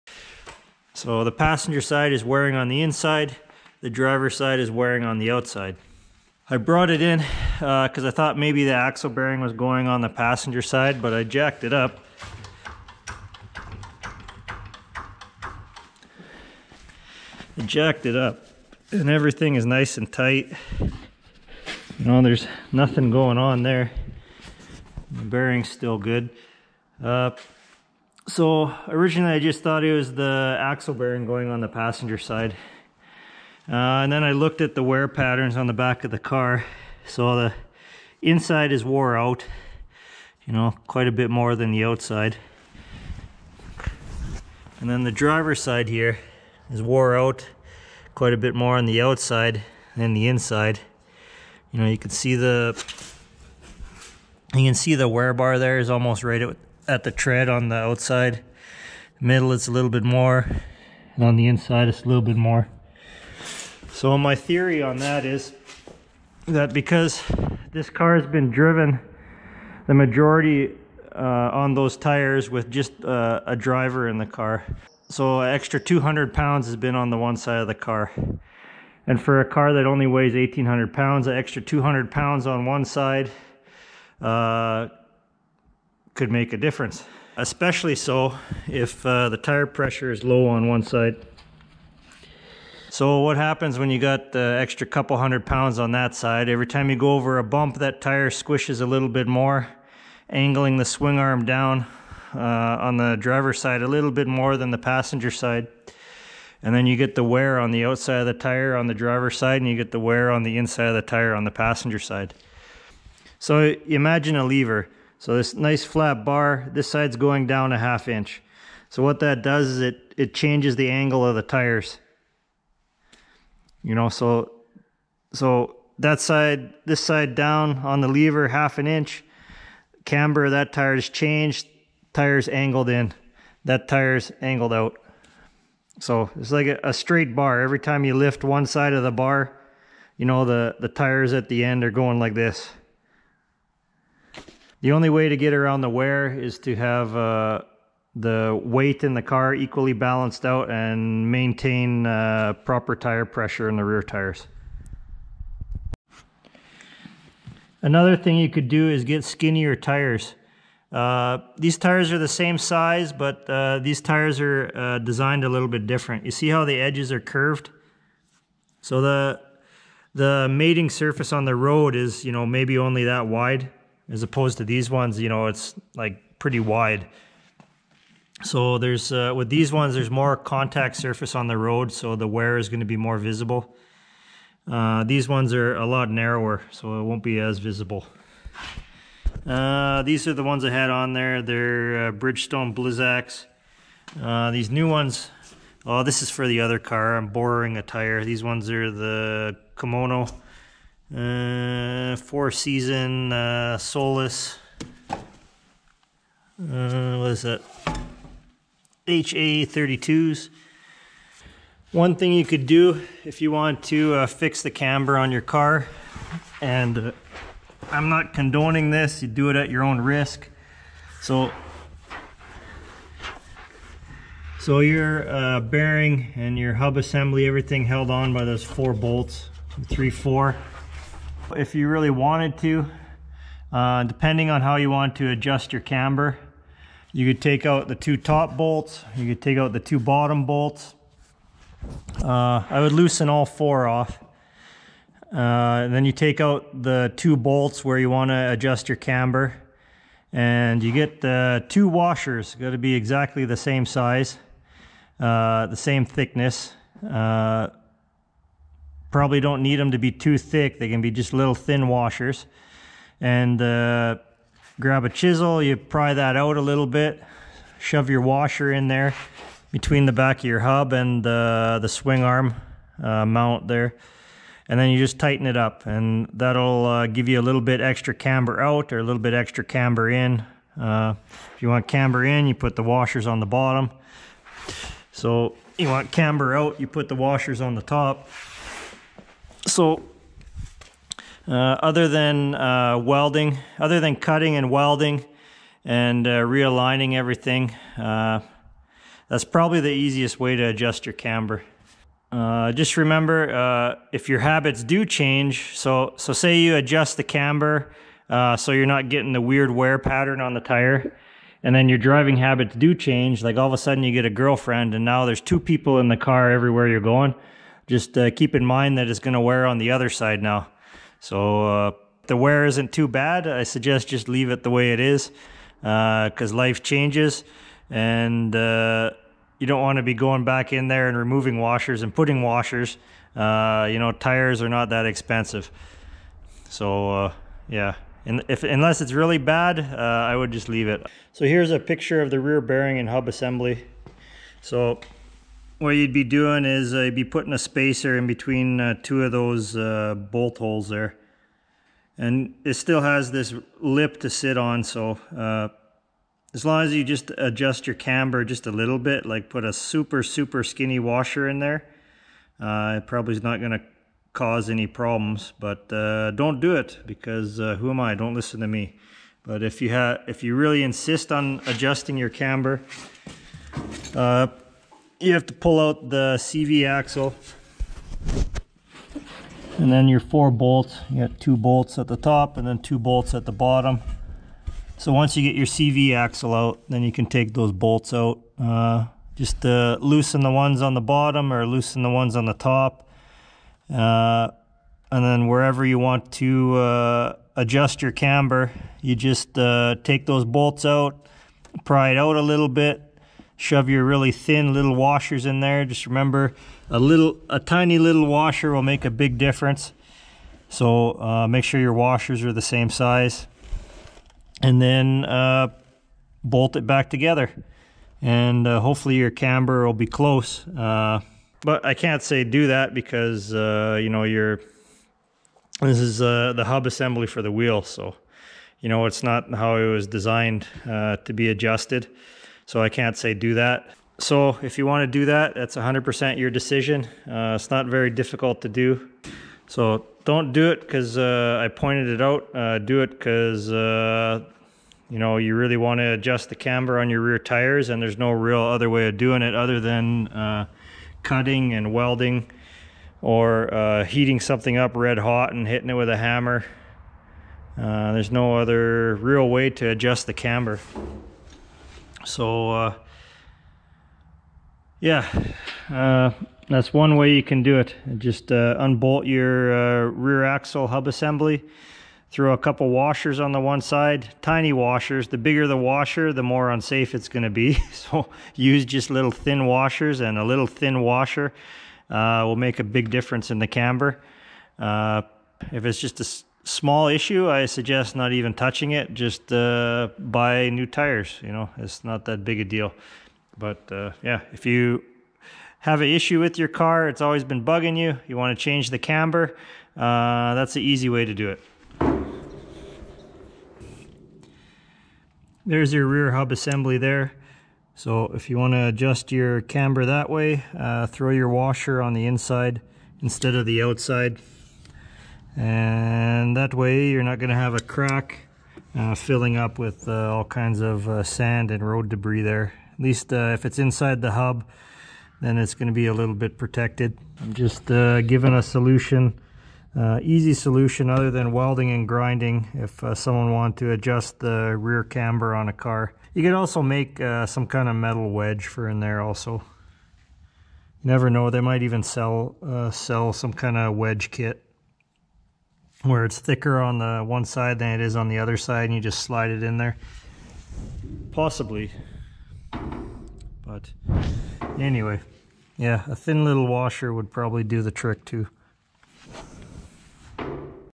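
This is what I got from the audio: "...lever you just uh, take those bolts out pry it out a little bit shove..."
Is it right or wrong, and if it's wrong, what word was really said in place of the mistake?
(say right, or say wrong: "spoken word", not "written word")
wrong: "camber", not "lever".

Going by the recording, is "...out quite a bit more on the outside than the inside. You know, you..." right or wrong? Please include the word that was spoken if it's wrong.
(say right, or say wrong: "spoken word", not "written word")
right.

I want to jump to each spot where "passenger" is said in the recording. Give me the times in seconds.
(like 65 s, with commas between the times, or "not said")
1 s, 10 s, 31 s, 104 s, 111 s.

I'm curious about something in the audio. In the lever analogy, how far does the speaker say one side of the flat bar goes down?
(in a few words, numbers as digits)
half an inch.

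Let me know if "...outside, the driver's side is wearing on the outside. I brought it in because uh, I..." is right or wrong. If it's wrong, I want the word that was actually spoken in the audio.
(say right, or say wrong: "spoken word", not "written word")
wrong: "inside", not "outside".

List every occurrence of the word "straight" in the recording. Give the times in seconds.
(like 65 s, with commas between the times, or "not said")
136 s.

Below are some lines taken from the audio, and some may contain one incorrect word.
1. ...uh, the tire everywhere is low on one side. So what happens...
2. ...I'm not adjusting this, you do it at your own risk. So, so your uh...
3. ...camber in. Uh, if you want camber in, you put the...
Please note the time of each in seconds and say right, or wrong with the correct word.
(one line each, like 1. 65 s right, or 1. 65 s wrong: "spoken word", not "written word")
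1. 89 s wrong: "pressure", not "everywhere"
2. 217 s wrong: "condoning", not "adjusting"
3. 279 s right.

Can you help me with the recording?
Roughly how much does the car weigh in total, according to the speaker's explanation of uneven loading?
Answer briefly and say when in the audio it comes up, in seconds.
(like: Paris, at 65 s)
1,800 pounds, at 80 s.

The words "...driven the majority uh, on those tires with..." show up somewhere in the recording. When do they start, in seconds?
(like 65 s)
68 s.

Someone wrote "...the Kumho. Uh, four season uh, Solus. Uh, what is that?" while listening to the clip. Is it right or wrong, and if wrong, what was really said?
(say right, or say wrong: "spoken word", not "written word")
right.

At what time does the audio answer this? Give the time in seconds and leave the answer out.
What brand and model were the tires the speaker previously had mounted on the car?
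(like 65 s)
192 s.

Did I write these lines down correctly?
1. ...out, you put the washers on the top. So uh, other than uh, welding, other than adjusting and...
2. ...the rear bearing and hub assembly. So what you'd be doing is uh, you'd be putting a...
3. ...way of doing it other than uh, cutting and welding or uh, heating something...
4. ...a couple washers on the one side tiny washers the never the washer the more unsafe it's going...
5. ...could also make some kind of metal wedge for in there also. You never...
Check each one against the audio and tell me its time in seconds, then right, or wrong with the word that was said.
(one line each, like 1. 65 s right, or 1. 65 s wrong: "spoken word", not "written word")
1. 286 s wrong: "cutting", not "adjusting"
2. 342 s right
3. 448 s right
4. 472 s wrong: "bigger", not "never"
5. 536 s right.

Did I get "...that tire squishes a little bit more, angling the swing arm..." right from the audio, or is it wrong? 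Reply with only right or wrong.
right.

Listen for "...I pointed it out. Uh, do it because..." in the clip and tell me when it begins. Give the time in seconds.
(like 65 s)
441 s.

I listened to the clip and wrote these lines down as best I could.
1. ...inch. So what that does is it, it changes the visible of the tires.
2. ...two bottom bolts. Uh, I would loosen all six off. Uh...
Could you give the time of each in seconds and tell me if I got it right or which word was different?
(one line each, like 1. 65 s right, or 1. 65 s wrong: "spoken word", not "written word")
1. 118 s wrong: "angle", not "visible"
2. 239 s wrong: "four", not "six".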